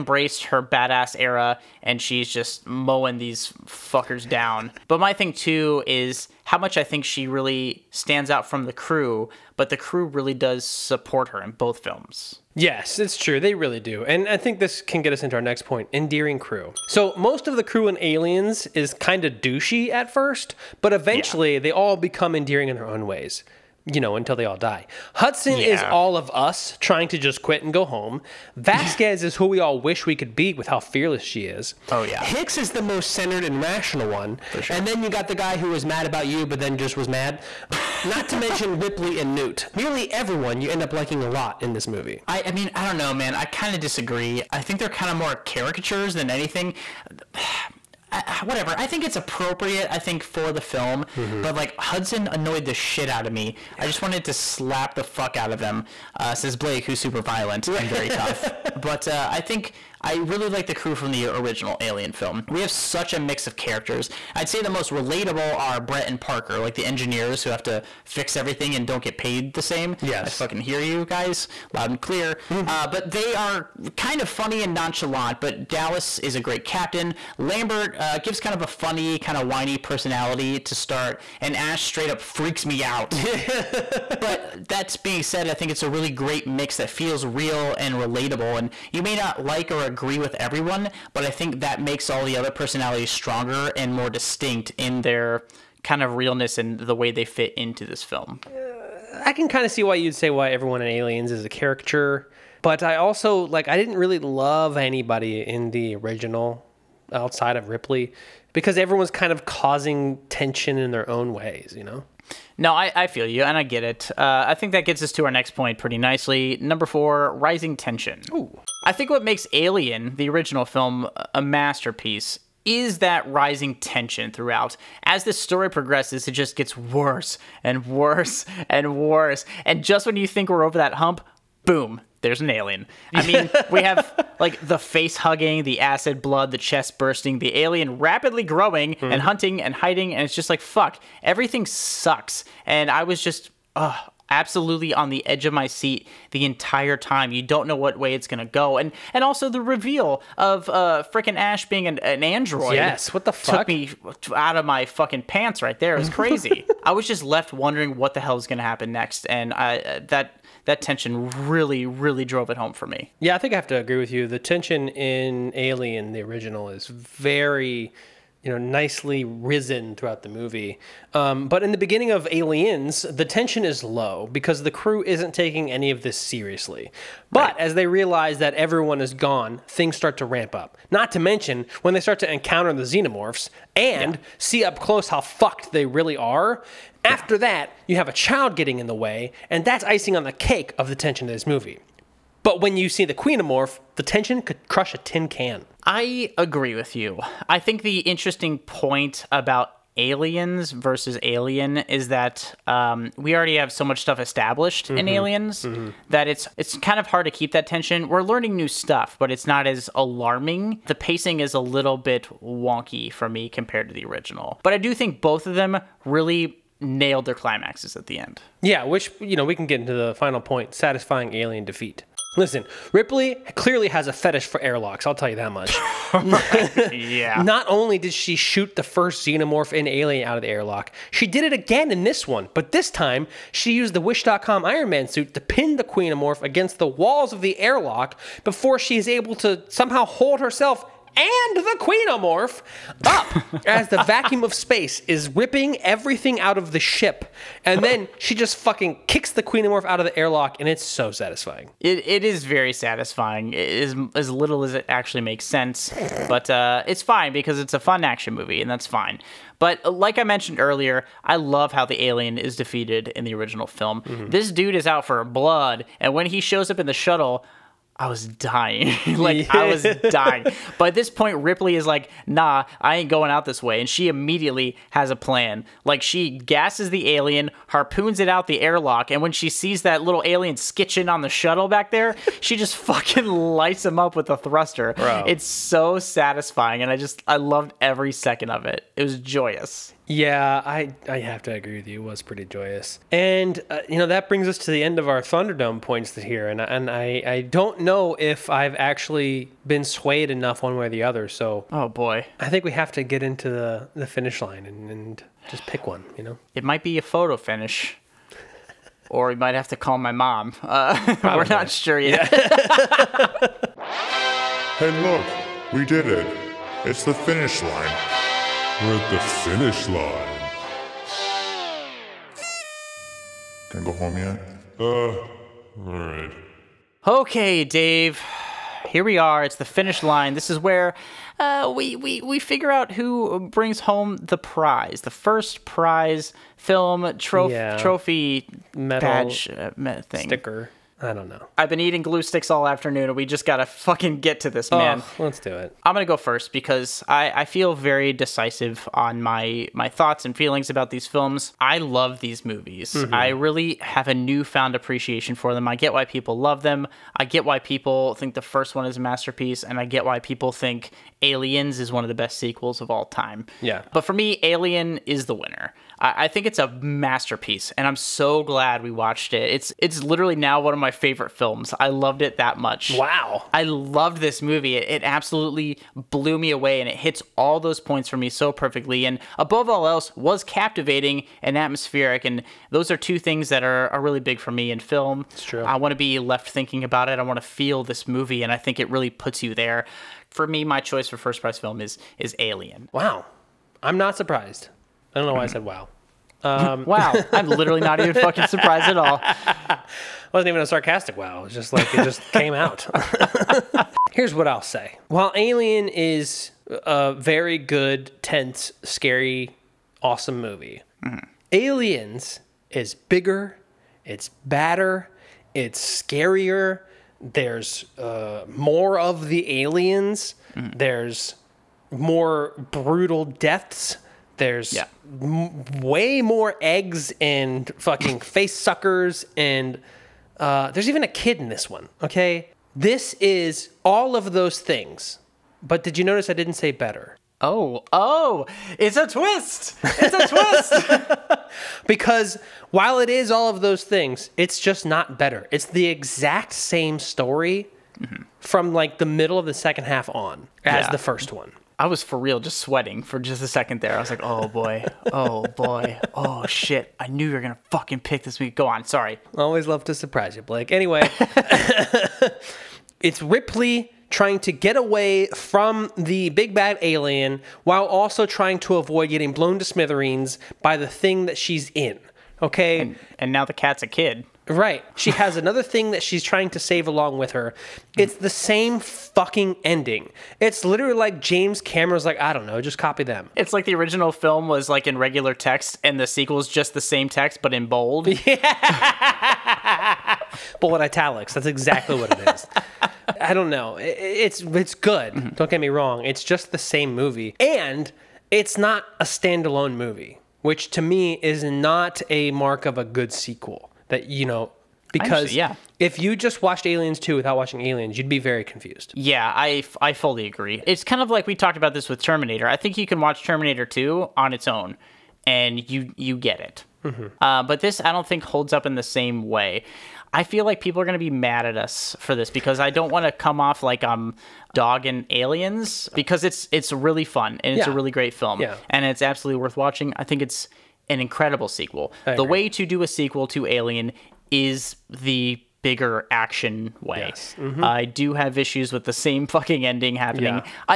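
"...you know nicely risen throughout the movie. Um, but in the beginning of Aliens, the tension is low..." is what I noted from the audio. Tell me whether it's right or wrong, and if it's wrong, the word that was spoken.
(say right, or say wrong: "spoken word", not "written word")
right.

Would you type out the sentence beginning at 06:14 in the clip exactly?
It, it absolutely blew me away, and it hits all those points for me so perfectly.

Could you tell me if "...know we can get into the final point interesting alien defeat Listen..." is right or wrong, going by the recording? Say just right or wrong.
wrong.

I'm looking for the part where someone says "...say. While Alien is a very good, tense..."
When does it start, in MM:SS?
06:44.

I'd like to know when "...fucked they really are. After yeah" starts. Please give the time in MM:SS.
03:05.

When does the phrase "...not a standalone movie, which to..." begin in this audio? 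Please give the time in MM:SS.
08:18.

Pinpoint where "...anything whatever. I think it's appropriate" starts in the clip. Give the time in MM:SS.
00:46.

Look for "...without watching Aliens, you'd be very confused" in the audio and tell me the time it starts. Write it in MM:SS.
08:27.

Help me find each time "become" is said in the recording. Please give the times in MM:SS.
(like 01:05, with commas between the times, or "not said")
00:21.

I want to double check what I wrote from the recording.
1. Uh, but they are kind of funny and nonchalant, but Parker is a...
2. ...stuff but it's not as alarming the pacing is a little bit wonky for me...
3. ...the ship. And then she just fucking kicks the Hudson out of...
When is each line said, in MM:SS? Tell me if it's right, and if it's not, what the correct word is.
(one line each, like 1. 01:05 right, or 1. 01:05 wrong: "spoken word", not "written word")
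1. 01:12 wrong: "Dallas", not "Parker"
2. 03:28 right
3. 04:06 wrong: "Queenomorph", not "Hudson".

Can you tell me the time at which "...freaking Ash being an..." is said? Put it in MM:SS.
02:31.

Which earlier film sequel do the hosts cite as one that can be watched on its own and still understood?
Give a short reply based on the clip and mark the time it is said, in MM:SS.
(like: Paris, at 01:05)
Terminator 2, at 08:33.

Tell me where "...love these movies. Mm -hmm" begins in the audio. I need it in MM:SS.
05:51.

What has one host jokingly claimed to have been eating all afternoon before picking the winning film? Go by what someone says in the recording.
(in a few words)
Glue sticks.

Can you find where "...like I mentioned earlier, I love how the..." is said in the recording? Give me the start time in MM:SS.
04:19.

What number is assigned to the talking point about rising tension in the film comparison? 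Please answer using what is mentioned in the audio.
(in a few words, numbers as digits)
4.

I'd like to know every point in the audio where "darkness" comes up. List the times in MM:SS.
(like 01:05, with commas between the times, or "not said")
not said.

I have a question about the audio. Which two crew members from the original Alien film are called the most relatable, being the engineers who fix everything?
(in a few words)
Brett and Parker.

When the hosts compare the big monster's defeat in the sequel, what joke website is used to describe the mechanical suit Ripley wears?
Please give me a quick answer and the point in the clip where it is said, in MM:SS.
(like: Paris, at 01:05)
Wish.com, at 03:54.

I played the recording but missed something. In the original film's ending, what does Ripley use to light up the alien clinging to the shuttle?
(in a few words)
A thruster.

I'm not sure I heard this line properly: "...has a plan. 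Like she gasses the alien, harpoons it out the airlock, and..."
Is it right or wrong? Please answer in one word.
right.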